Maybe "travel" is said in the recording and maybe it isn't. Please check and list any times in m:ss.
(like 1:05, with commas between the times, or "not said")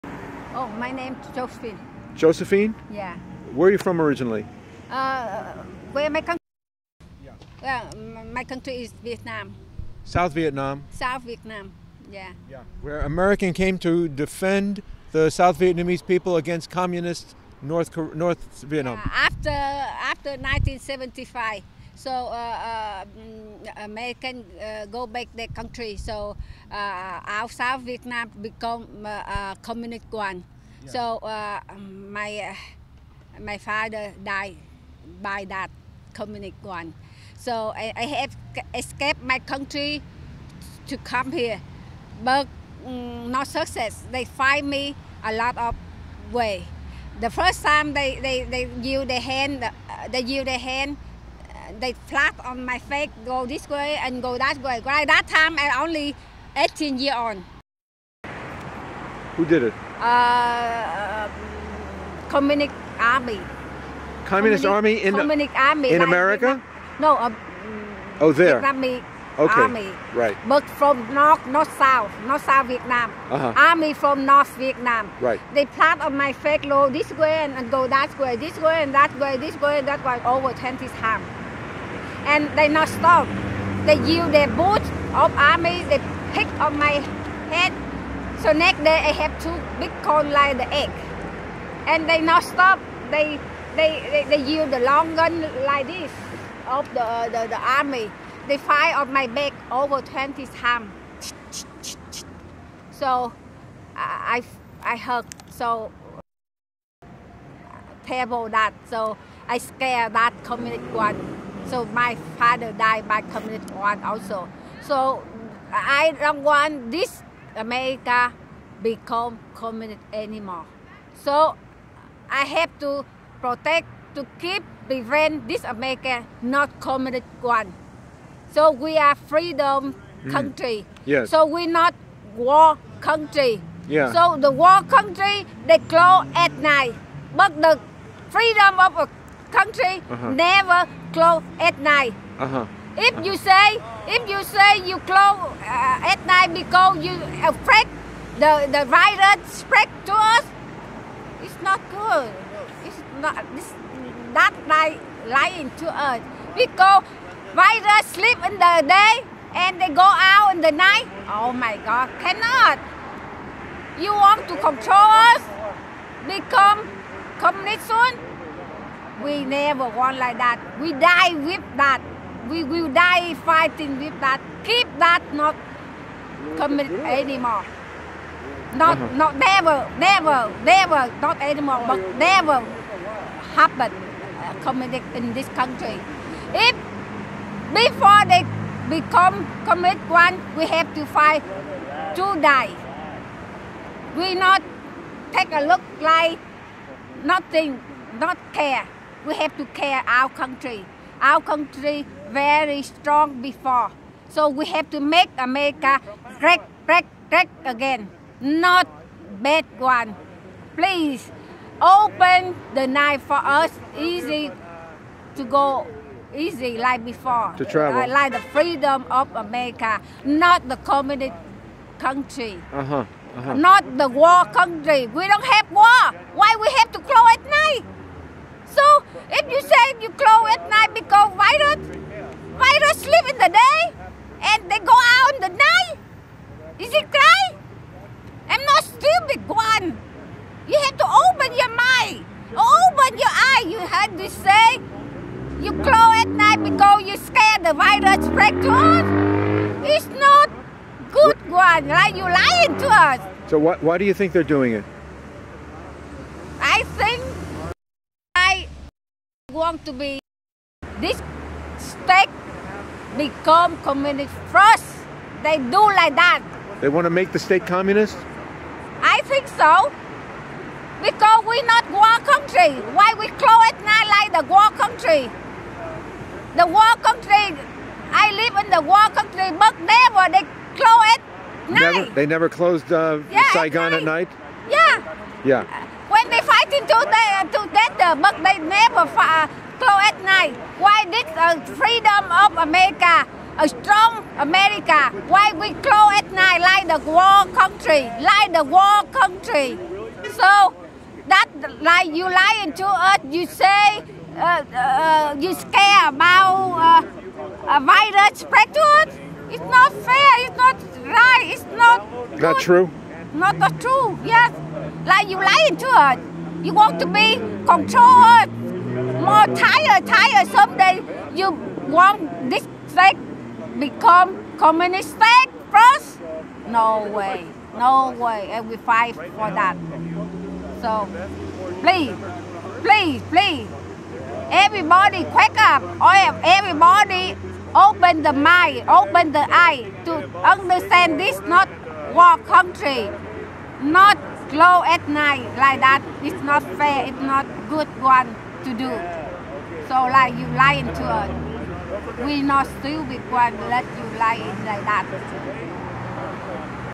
3:37.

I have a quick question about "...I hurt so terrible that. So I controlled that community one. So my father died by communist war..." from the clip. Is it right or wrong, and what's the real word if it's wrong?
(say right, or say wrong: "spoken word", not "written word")
wrong: "scared", not "controlled".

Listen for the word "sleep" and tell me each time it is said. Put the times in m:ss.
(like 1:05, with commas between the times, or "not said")
2:38, 3:53.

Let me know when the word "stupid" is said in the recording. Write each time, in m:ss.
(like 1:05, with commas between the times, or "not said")
3:58, 5:52.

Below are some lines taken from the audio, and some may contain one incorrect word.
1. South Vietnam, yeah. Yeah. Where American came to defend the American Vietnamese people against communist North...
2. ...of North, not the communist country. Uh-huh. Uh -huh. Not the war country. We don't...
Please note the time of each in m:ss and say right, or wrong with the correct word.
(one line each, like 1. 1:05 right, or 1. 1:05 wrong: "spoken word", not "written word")
1. 0:10 wrong: "South", not "American"
2. 3:39 wrong: "America", not "North".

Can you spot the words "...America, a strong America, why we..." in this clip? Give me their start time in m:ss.
4:52.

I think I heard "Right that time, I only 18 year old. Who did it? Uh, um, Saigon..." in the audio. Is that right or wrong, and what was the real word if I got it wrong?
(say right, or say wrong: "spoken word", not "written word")
wrong: "Communist", not "Saigon".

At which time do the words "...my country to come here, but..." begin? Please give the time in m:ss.
0:39.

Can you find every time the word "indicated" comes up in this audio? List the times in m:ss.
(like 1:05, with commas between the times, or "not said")
not said.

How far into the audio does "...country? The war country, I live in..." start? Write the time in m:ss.
4:34.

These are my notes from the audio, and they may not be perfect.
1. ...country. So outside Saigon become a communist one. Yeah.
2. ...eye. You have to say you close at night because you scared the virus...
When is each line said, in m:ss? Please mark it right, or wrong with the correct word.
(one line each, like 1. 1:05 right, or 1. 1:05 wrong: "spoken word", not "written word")
1. 0:25 wrong: "Vietnam", not "Saigon"
2. 4:03 right.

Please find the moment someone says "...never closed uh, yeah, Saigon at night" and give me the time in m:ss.
4:42.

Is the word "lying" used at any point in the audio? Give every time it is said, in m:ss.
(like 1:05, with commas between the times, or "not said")
2:35, 4:12, 5:02, 5:15, 5:50.